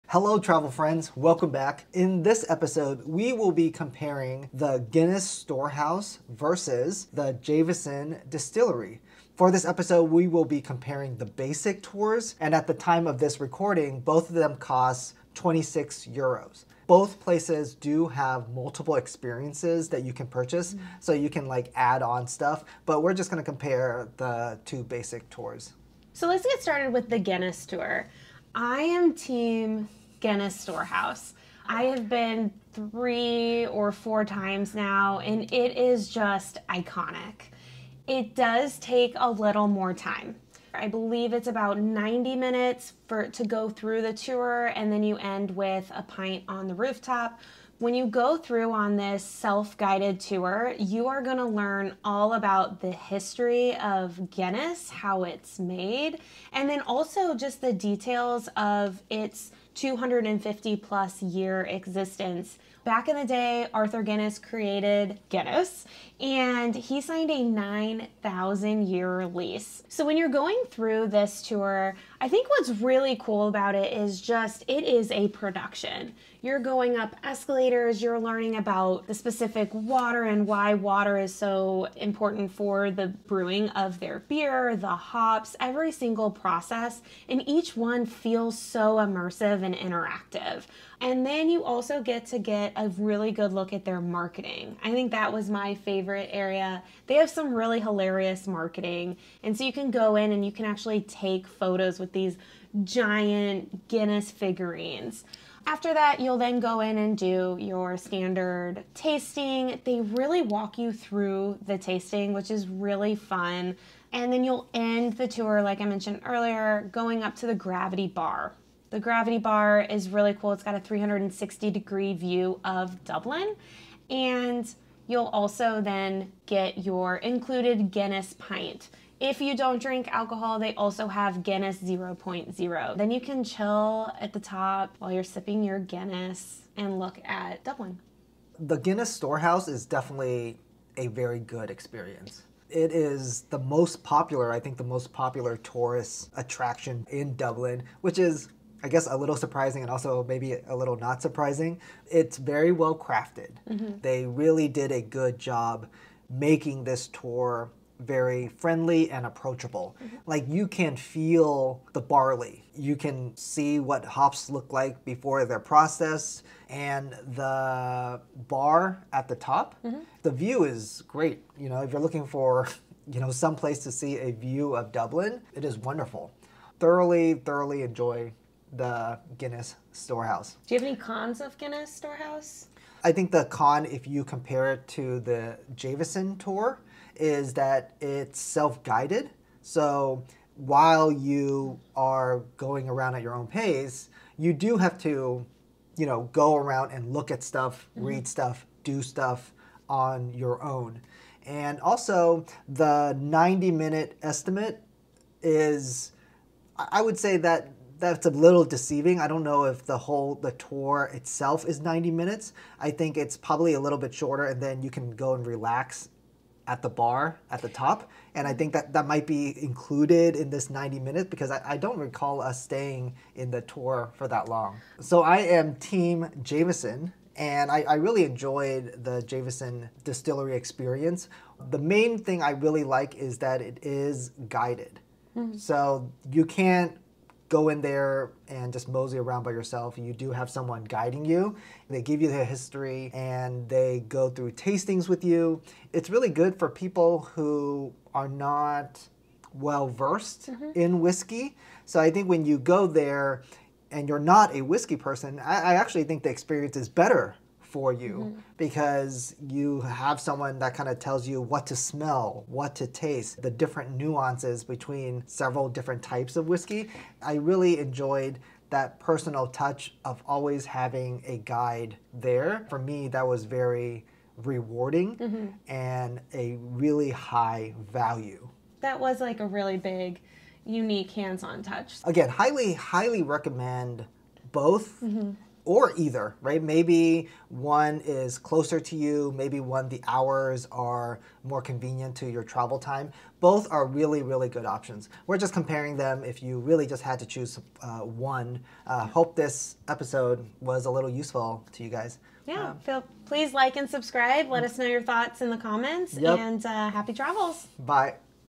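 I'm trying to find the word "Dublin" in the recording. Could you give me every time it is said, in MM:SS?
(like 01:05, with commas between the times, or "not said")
02:03, 02:17, 02:27, 02:54.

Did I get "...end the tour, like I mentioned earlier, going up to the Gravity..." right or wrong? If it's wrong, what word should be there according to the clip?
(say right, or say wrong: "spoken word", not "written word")
right.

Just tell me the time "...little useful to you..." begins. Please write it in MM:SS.
05:00.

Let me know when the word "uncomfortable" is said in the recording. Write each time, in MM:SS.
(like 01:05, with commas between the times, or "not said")
not said.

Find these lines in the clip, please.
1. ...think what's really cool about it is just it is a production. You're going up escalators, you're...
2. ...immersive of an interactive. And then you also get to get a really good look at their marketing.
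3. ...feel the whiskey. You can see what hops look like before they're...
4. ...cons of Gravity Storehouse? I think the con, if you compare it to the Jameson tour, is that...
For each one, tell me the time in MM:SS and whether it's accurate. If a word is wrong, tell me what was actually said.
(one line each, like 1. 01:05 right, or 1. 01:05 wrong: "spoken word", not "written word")
1. 01:12 right
2. 01:28 right
3. 02:40 wrong: "barley", not "whiskey"
4. 03:00 wrong: "Guinness", not "Gravity".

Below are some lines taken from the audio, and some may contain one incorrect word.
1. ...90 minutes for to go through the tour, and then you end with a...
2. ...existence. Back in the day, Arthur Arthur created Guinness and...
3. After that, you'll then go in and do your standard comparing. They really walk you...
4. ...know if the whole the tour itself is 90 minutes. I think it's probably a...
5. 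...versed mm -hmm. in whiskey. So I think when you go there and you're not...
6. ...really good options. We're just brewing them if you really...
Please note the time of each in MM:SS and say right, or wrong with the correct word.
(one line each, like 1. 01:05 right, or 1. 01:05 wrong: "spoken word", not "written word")
1. 00:41 right
2. 01:01 wrong: "Guinness", not "Arthur"
3. 01:45 wrong: "tasting", not "comparing"
4. 03:29 right
5. 04:09 right
6. 04:54 wrong: "comparing", not "brewing".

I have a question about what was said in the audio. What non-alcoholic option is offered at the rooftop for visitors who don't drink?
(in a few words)
Guinness 0.0.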